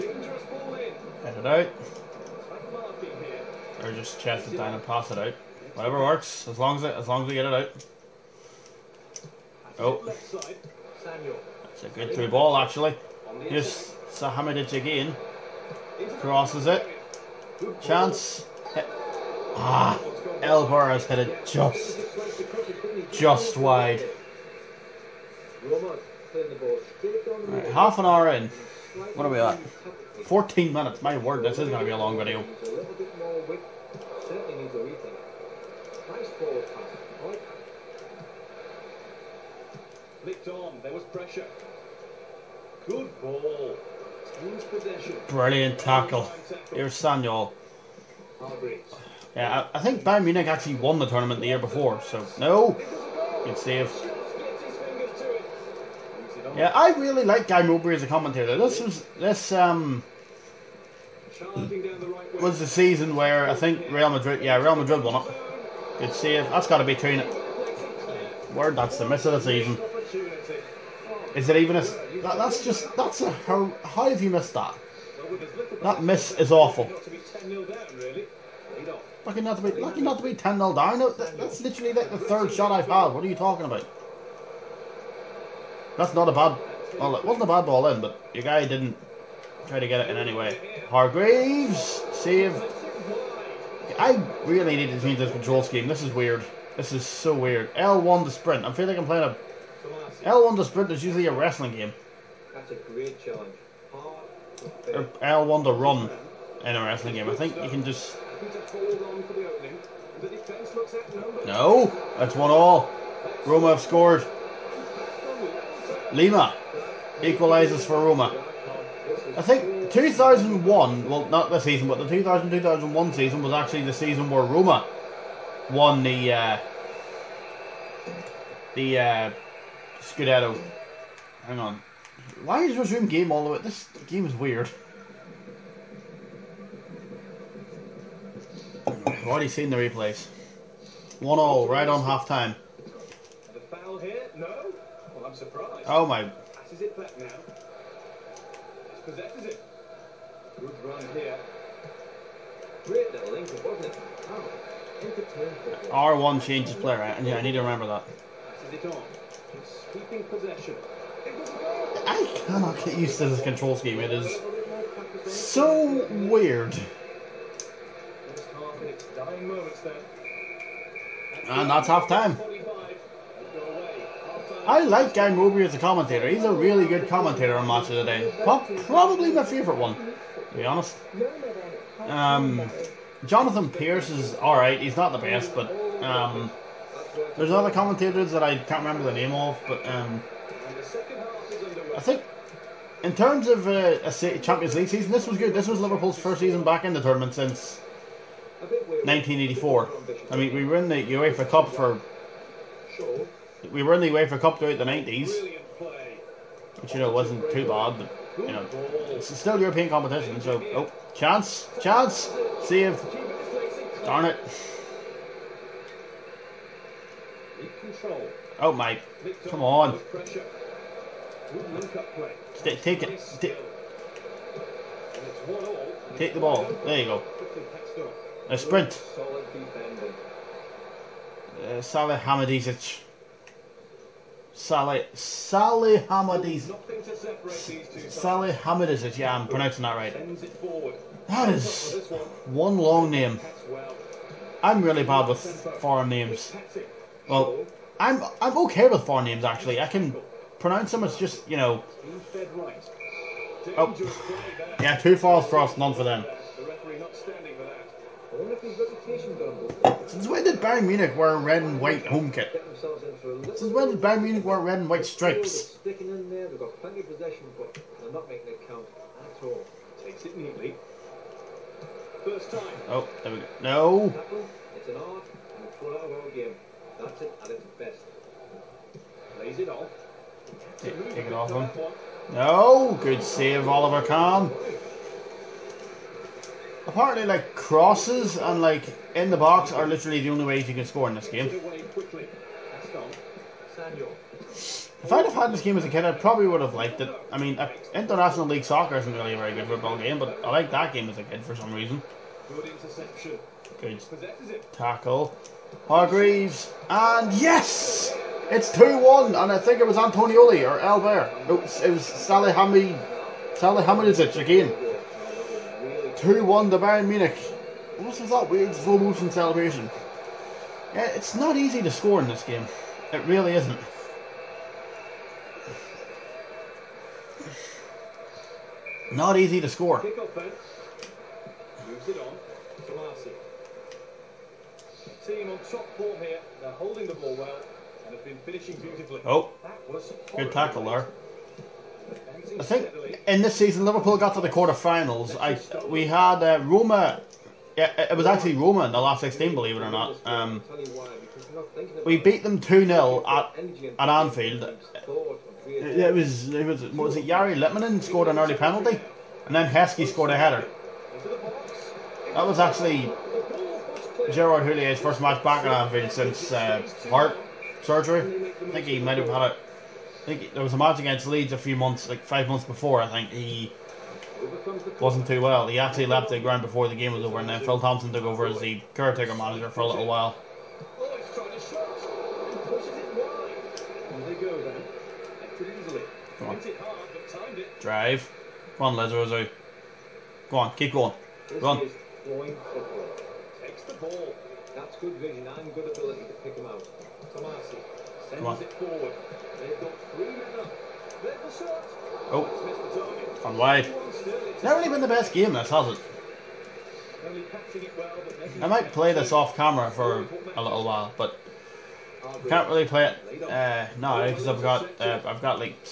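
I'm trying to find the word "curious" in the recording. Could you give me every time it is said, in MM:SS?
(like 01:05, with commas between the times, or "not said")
not said.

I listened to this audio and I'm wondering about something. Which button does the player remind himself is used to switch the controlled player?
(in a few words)
R1.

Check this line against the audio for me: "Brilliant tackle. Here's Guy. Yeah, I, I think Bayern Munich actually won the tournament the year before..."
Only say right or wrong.
wrong.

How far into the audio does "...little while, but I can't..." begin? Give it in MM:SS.
06:50.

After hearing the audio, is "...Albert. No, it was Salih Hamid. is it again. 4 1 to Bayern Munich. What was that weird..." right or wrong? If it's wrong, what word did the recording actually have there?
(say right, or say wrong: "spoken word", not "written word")
wrong: "2", not "4".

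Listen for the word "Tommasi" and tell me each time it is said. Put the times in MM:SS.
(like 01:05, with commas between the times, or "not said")
06:37.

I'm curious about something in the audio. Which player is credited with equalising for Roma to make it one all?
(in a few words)
Lima.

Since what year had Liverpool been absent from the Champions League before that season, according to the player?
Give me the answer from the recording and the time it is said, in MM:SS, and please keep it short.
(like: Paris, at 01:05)
1984, at 03:18.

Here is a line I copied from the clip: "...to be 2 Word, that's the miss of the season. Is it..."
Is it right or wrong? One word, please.
right.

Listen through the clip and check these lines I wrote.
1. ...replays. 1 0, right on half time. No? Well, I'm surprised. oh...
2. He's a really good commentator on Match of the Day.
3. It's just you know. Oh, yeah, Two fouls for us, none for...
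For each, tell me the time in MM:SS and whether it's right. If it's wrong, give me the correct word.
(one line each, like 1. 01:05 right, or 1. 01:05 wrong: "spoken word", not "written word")
1. 02:19 right
2. 02:56 right
3. 04:11 right.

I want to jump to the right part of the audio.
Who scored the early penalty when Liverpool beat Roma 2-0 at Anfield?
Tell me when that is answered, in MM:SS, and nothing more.
05:57.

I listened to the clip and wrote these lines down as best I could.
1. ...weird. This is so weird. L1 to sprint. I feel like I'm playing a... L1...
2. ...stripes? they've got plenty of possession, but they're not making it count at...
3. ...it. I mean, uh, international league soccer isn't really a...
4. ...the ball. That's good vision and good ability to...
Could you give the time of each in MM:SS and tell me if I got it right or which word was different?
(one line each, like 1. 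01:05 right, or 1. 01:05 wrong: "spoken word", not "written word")
1. 01:36 right
2. 04:25 right
3. 04:57 right
4. 06:33 right.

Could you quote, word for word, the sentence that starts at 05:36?
They're holding the ball well and have been finishing beautifully.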